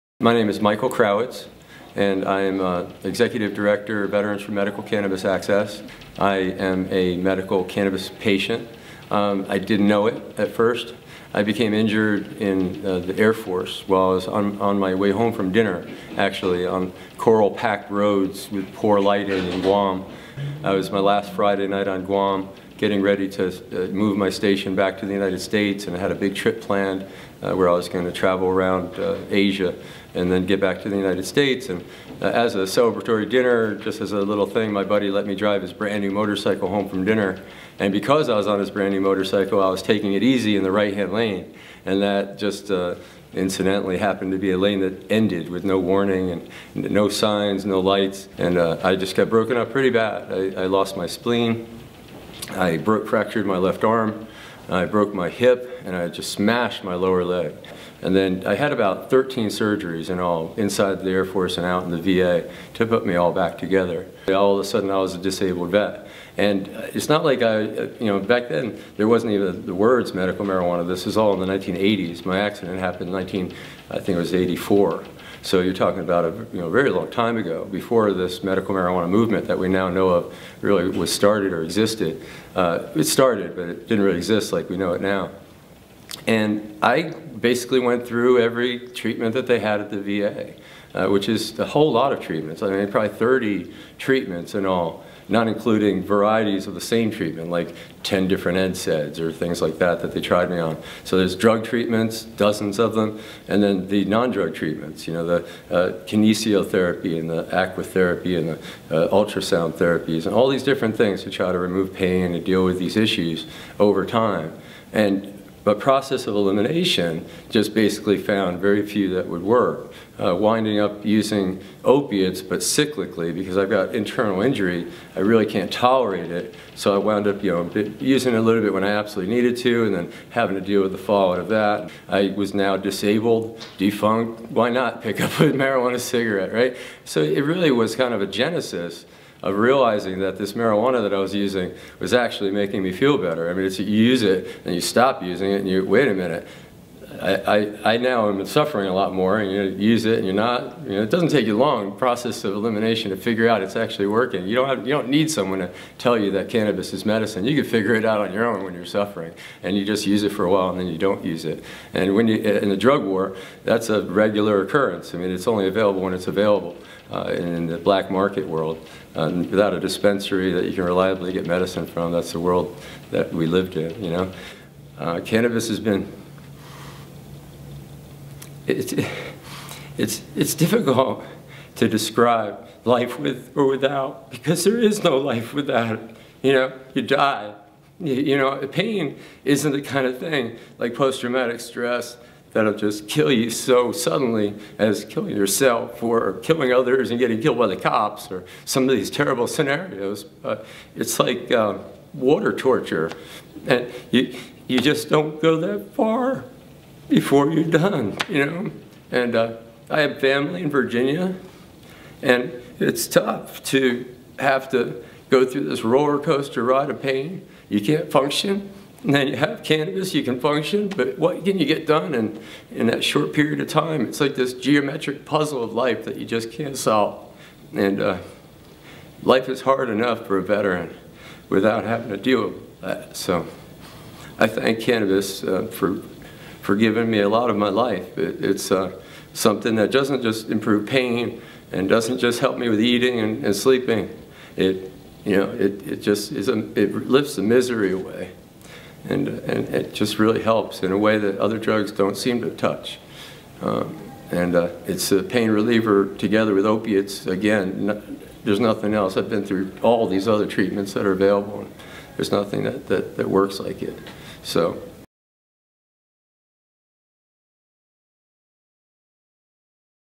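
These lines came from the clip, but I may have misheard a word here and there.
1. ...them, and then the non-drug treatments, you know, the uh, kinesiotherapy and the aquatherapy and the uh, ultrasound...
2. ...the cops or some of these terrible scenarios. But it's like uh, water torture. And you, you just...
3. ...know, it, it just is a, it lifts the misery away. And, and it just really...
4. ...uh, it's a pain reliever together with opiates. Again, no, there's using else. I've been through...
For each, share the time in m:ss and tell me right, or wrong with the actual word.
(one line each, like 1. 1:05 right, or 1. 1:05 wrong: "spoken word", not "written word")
1. 1:42 right
2. 3:17 right
3. 4:05 right
4. 4:14 wrong: "nothing", not "using".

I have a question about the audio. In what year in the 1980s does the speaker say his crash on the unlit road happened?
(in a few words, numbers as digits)
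1984.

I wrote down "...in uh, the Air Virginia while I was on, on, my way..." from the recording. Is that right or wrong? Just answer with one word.
wrong.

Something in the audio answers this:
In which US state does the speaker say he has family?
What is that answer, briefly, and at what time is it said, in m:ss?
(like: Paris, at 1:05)
Virginia, at 3:30.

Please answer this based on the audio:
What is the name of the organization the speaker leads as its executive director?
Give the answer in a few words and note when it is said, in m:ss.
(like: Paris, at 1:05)
Veterans for Medical Cannabis Access, at 0:04.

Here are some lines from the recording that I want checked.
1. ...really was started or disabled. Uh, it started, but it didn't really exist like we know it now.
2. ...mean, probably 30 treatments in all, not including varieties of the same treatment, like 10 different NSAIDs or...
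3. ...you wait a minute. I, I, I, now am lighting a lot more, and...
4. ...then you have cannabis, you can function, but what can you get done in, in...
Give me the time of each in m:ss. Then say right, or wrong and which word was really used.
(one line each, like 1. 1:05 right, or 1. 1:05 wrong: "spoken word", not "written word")
1. 1:20 wrong: "existed", not "disabled"
2. 1:32 right
3. 2:25 wrong: "suffering", not "lighting"
4. 3:39 right.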